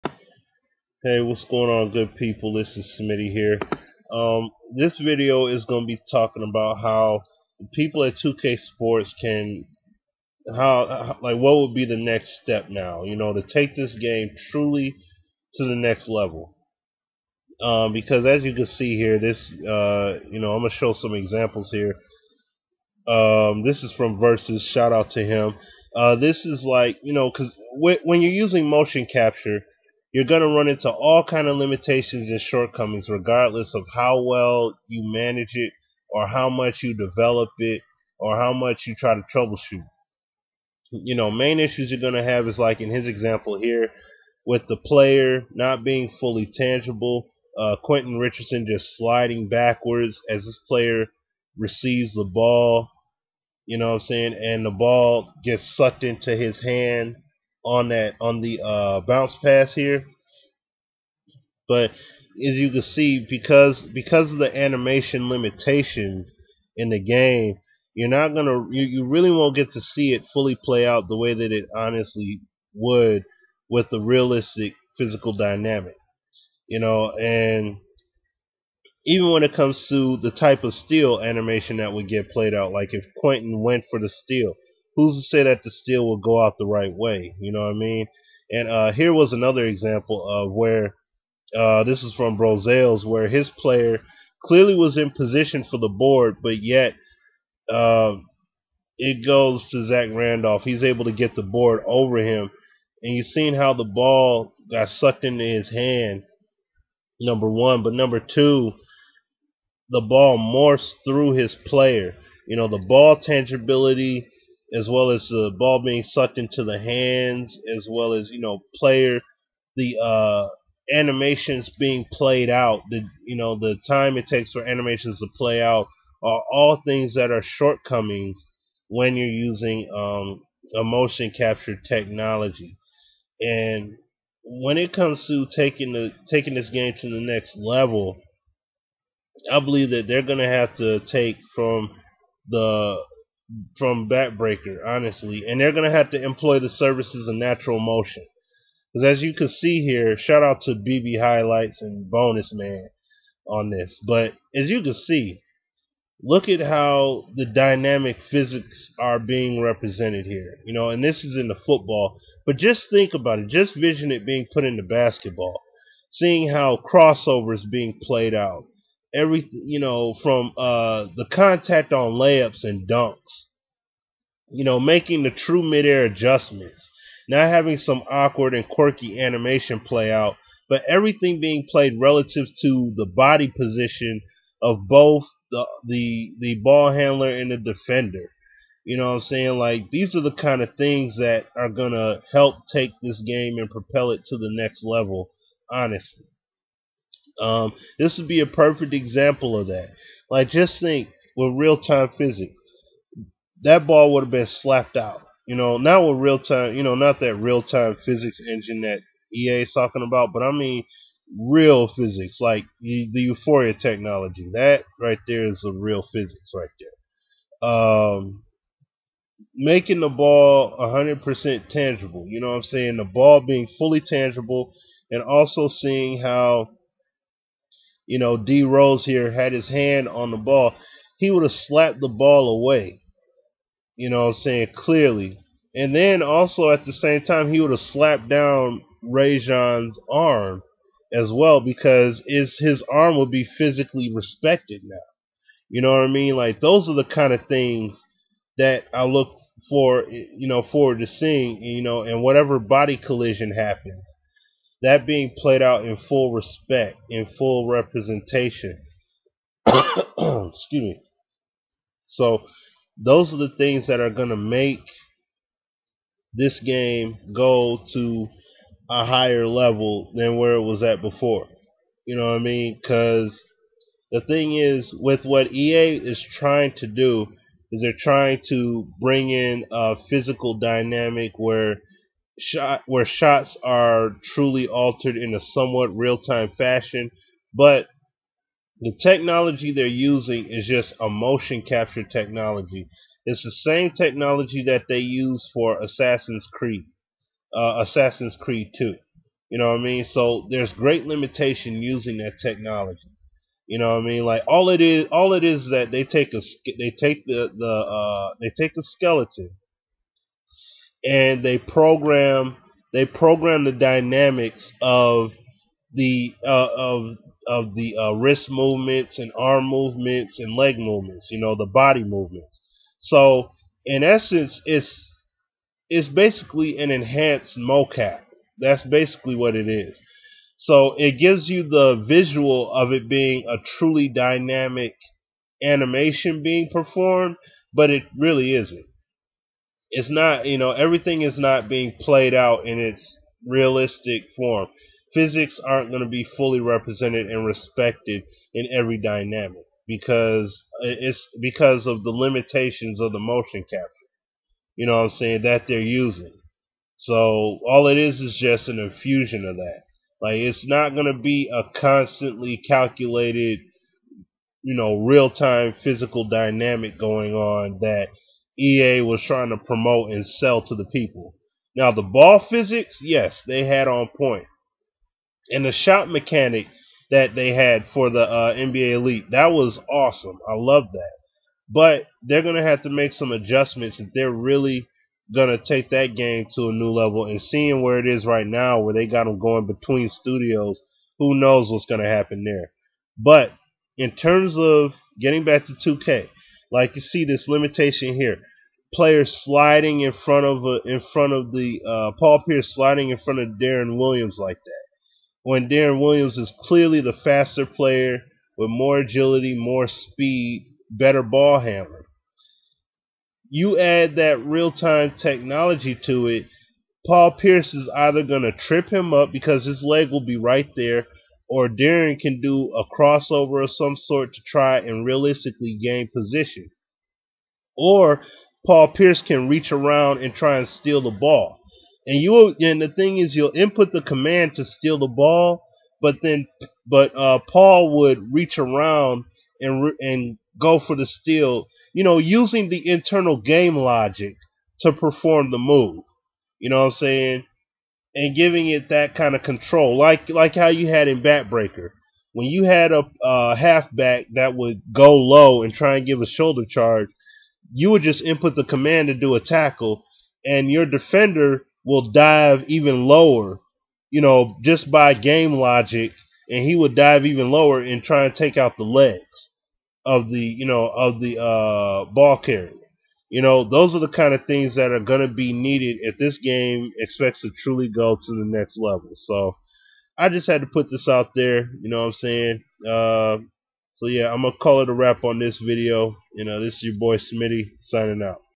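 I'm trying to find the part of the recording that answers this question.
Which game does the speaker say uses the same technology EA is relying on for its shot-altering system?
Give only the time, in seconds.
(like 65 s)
297 s.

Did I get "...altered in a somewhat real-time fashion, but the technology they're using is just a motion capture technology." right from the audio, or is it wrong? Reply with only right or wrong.
right.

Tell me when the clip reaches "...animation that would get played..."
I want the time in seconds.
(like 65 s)
81 s.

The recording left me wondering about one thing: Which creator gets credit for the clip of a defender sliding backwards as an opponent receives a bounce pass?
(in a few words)
Versuz.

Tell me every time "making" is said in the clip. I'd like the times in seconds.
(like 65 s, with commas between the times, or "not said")
174 s, 219 s.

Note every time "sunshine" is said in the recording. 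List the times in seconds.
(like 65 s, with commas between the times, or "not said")
not said.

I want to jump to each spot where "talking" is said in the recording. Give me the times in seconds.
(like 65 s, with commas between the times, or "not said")
6 s, 209 s.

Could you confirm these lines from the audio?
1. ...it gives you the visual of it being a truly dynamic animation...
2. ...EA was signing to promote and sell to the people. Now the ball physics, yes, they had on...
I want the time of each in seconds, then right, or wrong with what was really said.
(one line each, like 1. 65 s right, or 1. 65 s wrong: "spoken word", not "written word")
1. 330 s right
2. 368 s wrong: "trying", not "signing".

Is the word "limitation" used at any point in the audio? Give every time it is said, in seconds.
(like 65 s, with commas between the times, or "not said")
31 s, 65 s, 301 s, 352 s, 397 s.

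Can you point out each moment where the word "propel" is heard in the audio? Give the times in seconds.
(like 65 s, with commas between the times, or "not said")
193 s.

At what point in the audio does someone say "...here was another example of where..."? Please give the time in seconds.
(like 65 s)
88 s.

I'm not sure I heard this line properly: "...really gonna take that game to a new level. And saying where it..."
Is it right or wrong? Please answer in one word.
wrong.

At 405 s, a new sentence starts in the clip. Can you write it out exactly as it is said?
When Deron Williams is clearly the faster player with more agility, more speed, better ball handling.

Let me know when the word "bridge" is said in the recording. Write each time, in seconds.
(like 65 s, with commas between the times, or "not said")
not said.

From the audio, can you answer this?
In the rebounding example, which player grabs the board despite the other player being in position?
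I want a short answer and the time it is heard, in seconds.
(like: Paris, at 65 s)
Zach Randolph, at 99 s.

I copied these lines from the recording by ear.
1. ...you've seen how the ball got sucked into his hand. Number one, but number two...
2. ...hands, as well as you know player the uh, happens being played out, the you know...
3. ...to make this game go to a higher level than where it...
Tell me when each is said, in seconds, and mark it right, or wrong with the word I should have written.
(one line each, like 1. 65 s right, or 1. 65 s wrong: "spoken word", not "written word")
1. 103 s right
2. 116 s wrong: "animations", not "happens"
3. 264 s right.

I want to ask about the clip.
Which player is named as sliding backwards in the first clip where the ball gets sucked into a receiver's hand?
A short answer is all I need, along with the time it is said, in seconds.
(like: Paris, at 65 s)
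Quentin Richardson, at 47 s.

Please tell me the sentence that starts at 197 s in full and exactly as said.
Um, this would be a perfect example of that.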